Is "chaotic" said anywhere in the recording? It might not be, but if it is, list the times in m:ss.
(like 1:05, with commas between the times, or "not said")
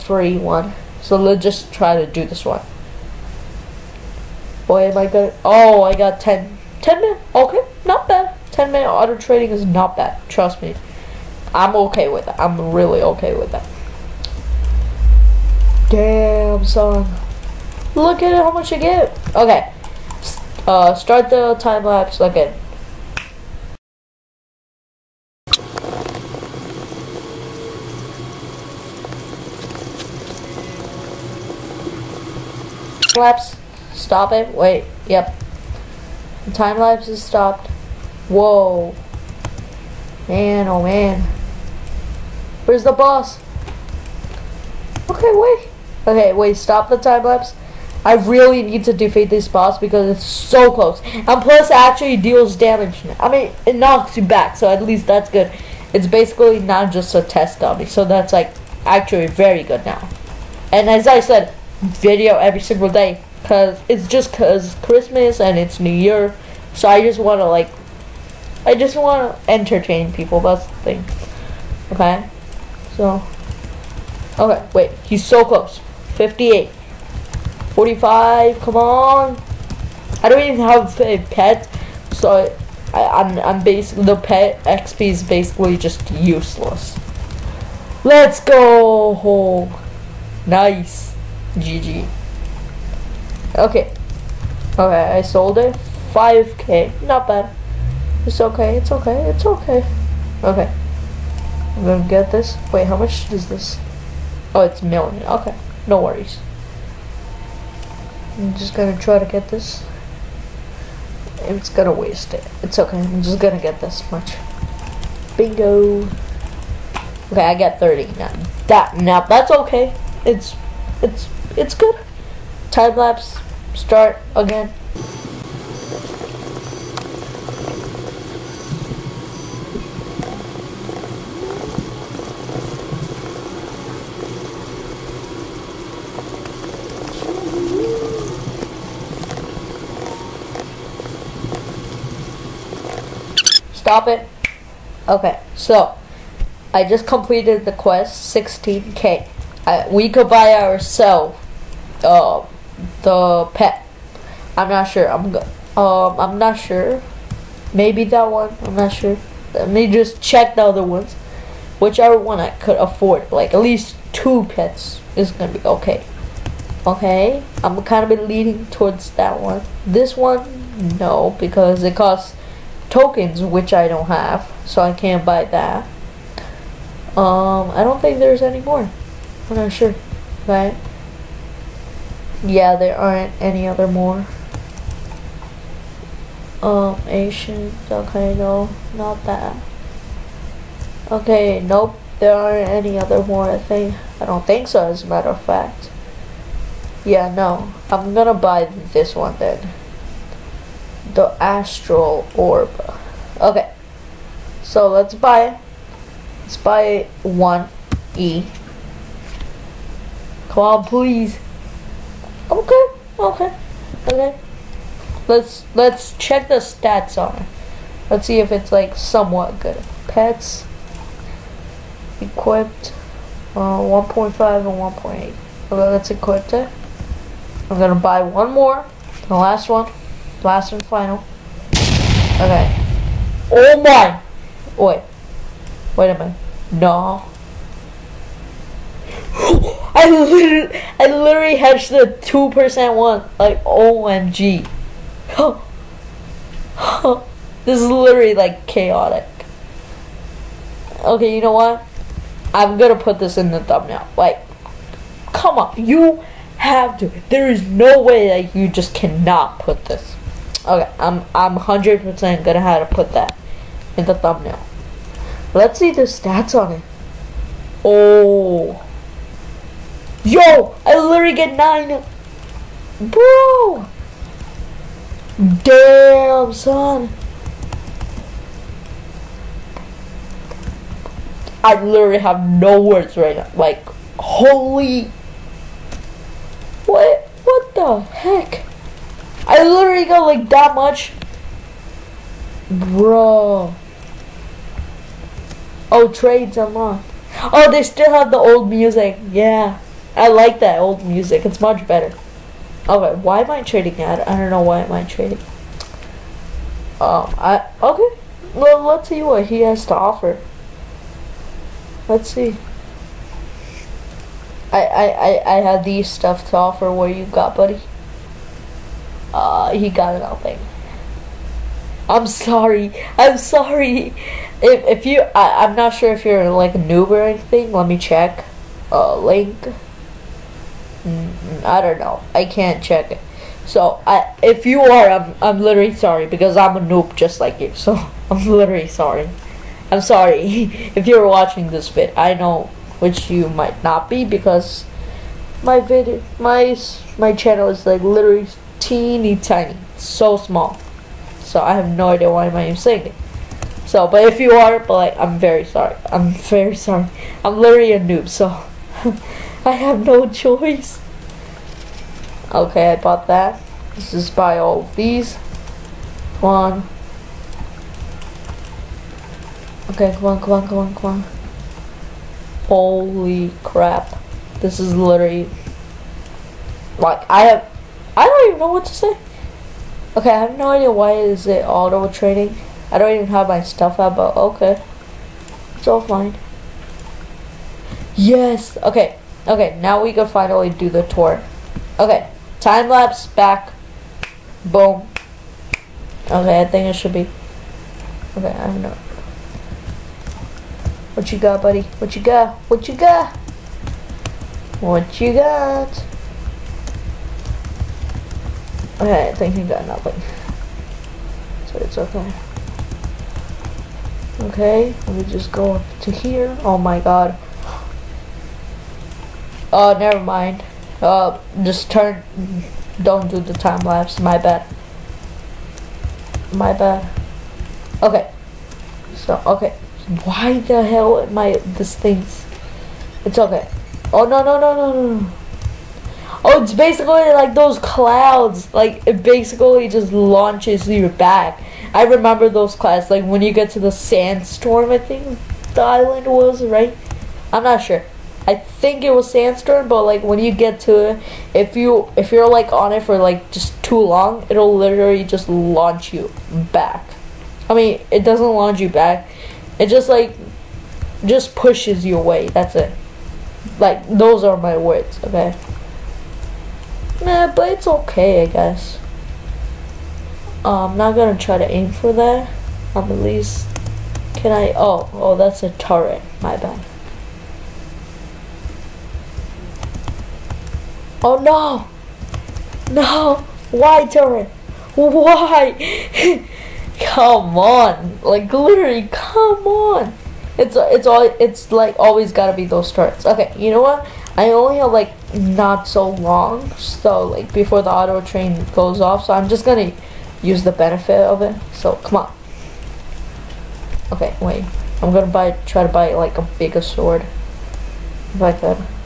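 4:08.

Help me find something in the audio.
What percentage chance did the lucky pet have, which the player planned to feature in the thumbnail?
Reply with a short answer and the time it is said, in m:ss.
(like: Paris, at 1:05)
2 percent, at 4:02.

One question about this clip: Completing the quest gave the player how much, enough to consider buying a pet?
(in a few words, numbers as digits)
16k.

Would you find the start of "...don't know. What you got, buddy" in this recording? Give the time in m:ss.
6:38.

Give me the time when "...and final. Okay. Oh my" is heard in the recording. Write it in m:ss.
3:50.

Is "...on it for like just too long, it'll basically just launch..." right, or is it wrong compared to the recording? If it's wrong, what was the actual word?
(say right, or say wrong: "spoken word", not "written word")
wrong: "literally", not "basically".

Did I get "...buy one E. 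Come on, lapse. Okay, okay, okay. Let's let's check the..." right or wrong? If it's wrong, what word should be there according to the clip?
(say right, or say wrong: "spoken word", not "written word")
wrong: "please", not "lapse".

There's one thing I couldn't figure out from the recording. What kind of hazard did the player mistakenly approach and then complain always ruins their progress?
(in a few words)
turret.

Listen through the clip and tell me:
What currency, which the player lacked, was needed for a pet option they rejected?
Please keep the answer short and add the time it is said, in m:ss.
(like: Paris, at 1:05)
tokens, at 2:52.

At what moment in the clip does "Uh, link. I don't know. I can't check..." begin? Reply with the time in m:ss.
5:28.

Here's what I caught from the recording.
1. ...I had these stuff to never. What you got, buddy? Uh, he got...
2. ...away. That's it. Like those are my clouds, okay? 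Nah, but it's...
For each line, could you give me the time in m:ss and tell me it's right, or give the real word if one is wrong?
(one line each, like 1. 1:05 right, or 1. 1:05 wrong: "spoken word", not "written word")
1. 5:15 wrong: "offer", not "never"
2. 7:42 wrong: "words", not "clouds".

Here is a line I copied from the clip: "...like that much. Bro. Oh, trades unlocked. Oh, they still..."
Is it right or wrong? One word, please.
right.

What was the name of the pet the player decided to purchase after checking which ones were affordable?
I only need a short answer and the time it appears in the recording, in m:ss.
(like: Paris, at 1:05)
Astral Orb, at 3:21.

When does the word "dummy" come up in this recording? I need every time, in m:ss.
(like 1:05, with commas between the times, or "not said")
0:57.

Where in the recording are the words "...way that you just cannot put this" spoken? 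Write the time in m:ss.
4:18.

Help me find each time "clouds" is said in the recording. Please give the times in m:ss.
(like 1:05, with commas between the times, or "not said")
7:17, 7:22.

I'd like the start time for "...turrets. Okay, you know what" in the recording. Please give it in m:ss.
8:12.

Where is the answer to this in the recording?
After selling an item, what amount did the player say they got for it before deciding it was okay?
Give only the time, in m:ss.
1:36.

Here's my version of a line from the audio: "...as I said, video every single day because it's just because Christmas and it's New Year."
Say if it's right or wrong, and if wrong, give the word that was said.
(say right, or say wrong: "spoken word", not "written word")
right.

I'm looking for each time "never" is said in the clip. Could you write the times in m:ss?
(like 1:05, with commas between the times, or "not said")
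6:59.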